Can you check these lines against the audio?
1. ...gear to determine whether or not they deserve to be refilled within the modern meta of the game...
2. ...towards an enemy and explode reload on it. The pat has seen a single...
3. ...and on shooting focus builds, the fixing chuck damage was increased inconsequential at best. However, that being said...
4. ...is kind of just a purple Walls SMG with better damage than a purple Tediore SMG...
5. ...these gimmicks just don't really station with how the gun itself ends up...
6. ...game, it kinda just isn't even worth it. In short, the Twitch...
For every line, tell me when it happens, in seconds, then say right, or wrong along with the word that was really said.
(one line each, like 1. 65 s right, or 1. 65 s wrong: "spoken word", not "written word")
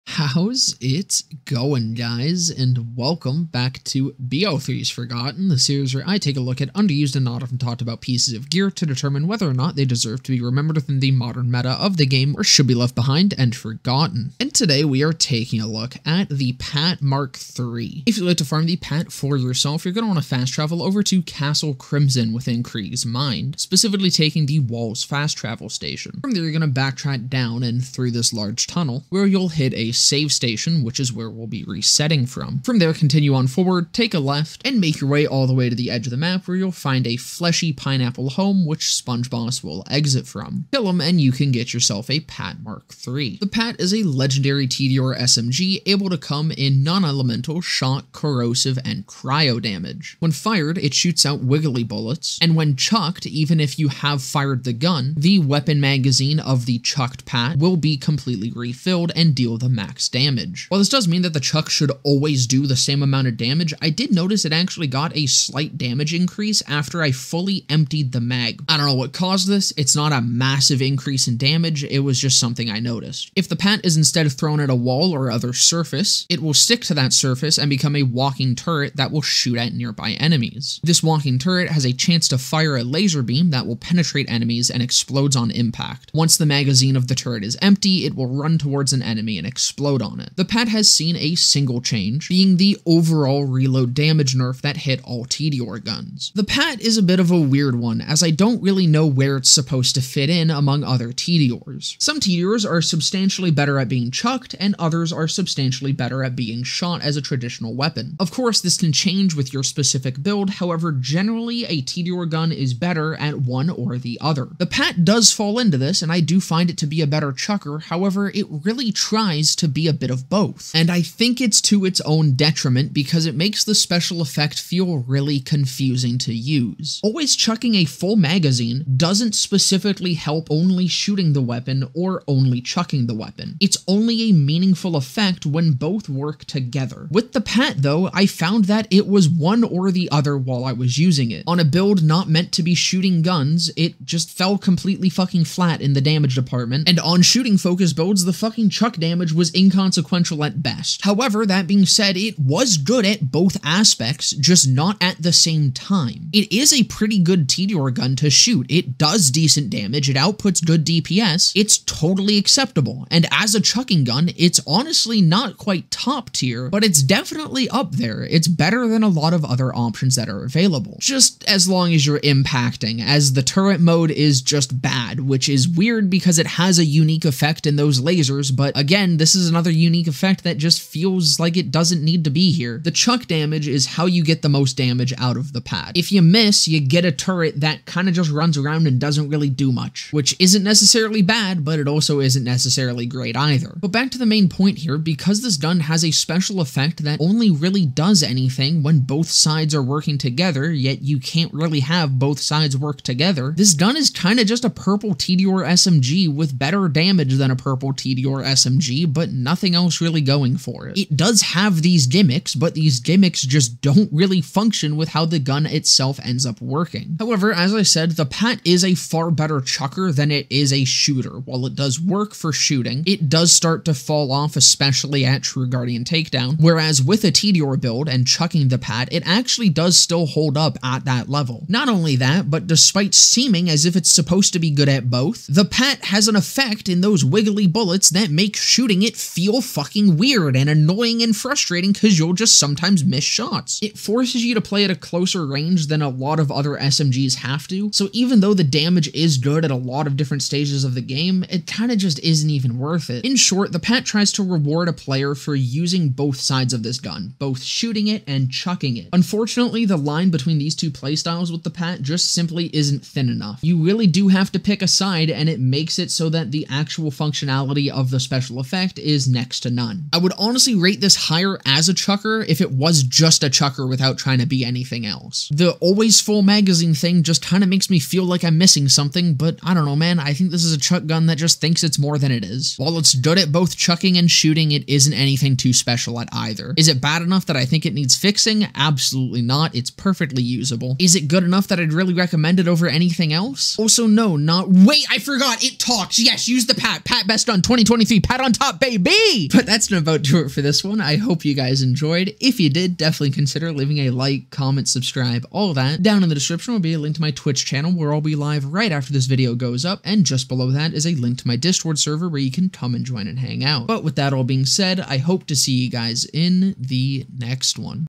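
1. 8 s wrong: "remembered", not "refilled"
2. 88 s right
3. 146 s wrong: "fucking", not "fixing"
4. 203 s wrong: "Tediore", not "Walls"
5. 212 s wrong: "function", not "station"
6. 251 s wrong: "PAT", not "Twitch".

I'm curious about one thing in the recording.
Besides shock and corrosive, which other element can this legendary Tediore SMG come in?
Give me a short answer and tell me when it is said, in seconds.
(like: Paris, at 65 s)
cryo, at 49 s.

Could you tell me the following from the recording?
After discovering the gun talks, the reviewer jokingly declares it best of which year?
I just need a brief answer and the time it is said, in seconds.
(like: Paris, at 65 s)
2023, at 297 s.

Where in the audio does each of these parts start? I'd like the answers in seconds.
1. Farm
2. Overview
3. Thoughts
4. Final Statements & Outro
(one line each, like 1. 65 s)
1. 18 s
2. 43 s
3. 96 s
4. 253 s.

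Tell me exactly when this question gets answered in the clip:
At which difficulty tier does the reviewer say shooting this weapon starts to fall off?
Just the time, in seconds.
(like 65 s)
225 s.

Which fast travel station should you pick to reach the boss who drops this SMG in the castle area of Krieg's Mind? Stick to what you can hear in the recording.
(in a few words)
Walls.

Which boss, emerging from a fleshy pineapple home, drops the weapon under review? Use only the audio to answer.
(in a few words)
Sponge Boss.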